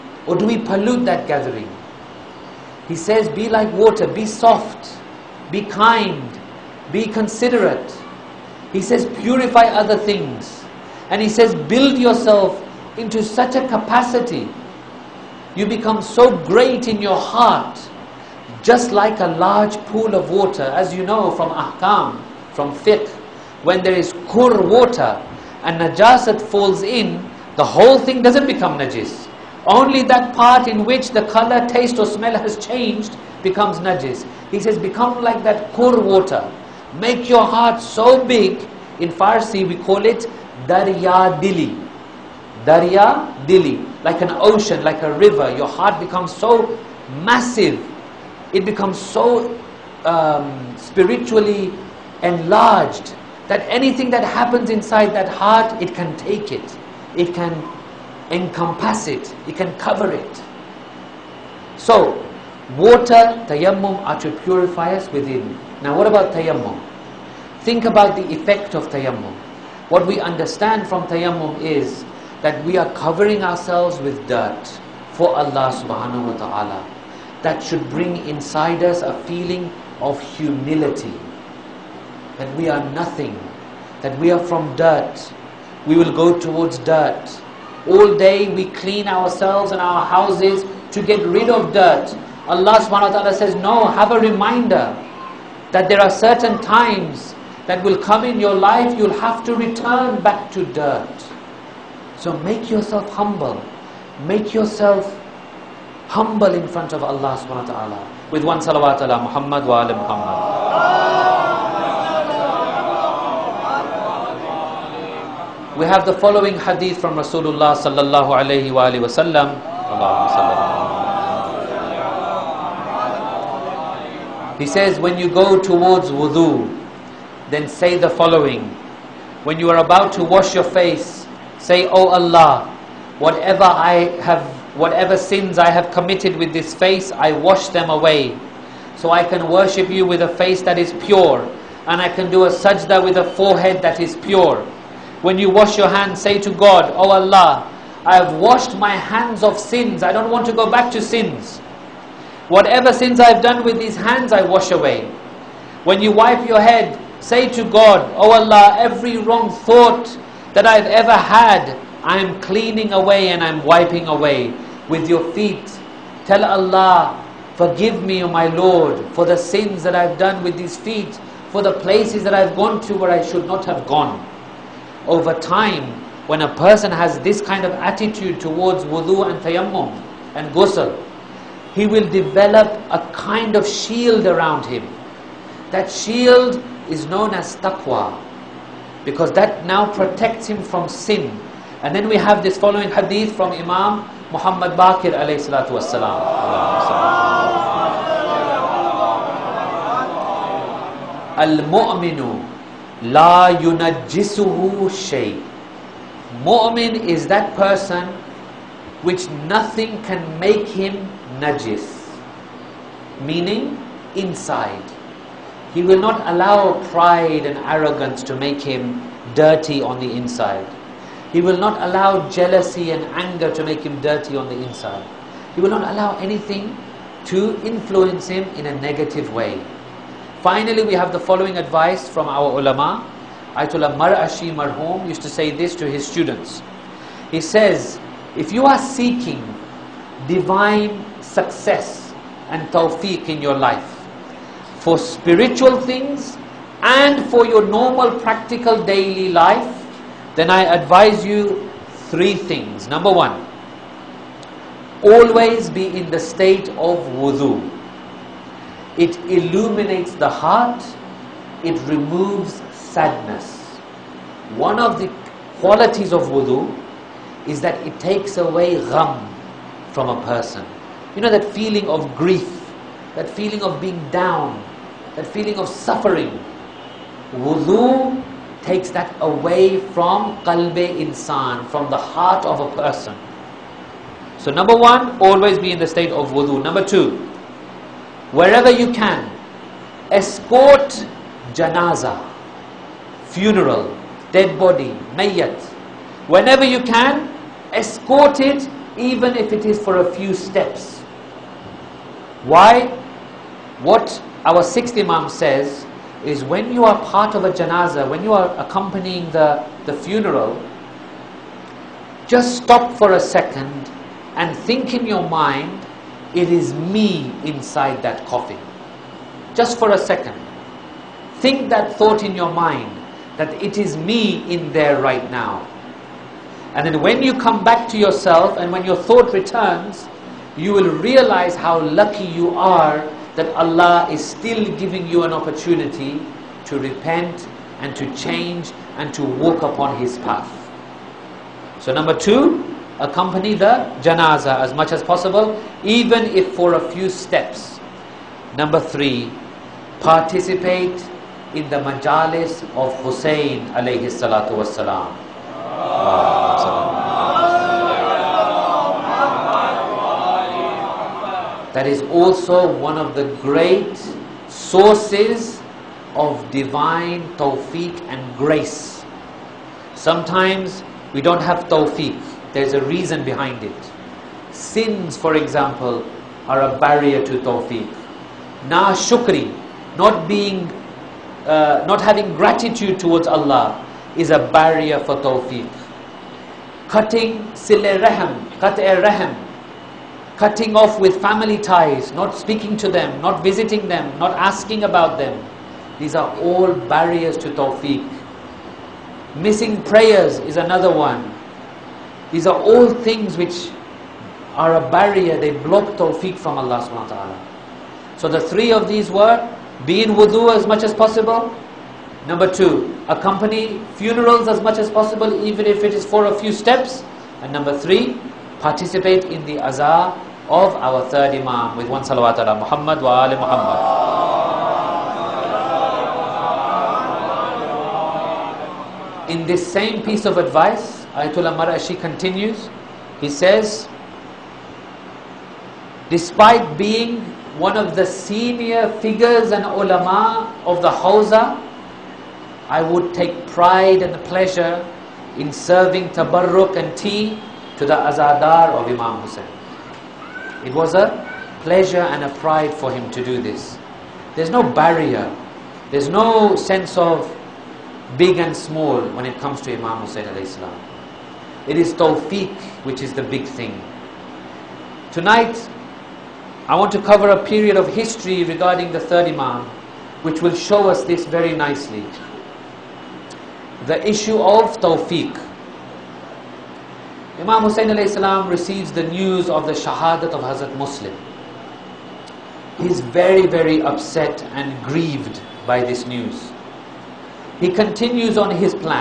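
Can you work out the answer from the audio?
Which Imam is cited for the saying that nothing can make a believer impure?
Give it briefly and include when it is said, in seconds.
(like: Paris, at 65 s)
Imam Muhammad Baqir, at 193 s.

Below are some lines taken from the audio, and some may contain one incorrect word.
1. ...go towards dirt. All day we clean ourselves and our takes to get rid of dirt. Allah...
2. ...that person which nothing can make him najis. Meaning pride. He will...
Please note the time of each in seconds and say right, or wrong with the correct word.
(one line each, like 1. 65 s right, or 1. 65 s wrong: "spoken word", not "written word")
1. 86 s wrong: "houses", not "takes"
2. 207 s wrong: "inside", not "pride".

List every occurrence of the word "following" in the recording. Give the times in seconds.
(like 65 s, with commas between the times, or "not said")
116 s, 128 s, 192 s, 231 s.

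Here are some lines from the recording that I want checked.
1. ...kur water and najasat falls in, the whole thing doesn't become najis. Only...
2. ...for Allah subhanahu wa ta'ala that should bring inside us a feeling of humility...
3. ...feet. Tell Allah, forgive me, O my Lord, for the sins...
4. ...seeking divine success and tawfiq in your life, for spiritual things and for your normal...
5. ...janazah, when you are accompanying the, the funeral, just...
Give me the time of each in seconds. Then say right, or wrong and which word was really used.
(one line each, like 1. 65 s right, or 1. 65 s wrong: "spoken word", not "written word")
1. 24 s right
2. 75 s right
3. 165 s right
4. 238 s right
5. 307 s right.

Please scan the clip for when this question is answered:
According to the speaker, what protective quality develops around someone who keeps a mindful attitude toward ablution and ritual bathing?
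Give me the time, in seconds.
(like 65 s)
187 s.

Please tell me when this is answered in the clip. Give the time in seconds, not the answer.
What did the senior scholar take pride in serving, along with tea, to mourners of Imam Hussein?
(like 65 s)
446 s.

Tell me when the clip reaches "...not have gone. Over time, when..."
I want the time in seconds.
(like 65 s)
173 s.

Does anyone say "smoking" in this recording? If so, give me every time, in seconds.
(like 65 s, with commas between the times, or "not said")
not said.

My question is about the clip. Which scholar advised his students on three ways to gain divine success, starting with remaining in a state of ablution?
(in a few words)
Ayatollah Mar'ashi.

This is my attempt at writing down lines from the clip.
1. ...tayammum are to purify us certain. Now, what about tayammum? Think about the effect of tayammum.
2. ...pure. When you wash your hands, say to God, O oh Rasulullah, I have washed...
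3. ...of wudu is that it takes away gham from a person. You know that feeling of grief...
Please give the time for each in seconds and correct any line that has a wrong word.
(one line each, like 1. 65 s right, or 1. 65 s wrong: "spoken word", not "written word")
1. 63 s wrong: "within", not "certain"
2. 144 s wrong: "Allah", not "Rasulullah"
3. 266 s right.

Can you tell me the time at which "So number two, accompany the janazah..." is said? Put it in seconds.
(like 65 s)
341 s.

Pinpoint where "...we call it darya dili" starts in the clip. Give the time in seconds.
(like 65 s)
39 s.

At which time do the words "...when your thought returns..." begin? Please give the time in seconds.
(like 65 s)
328 s.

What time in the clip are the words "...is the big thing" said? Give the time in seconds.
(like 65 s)
463 s.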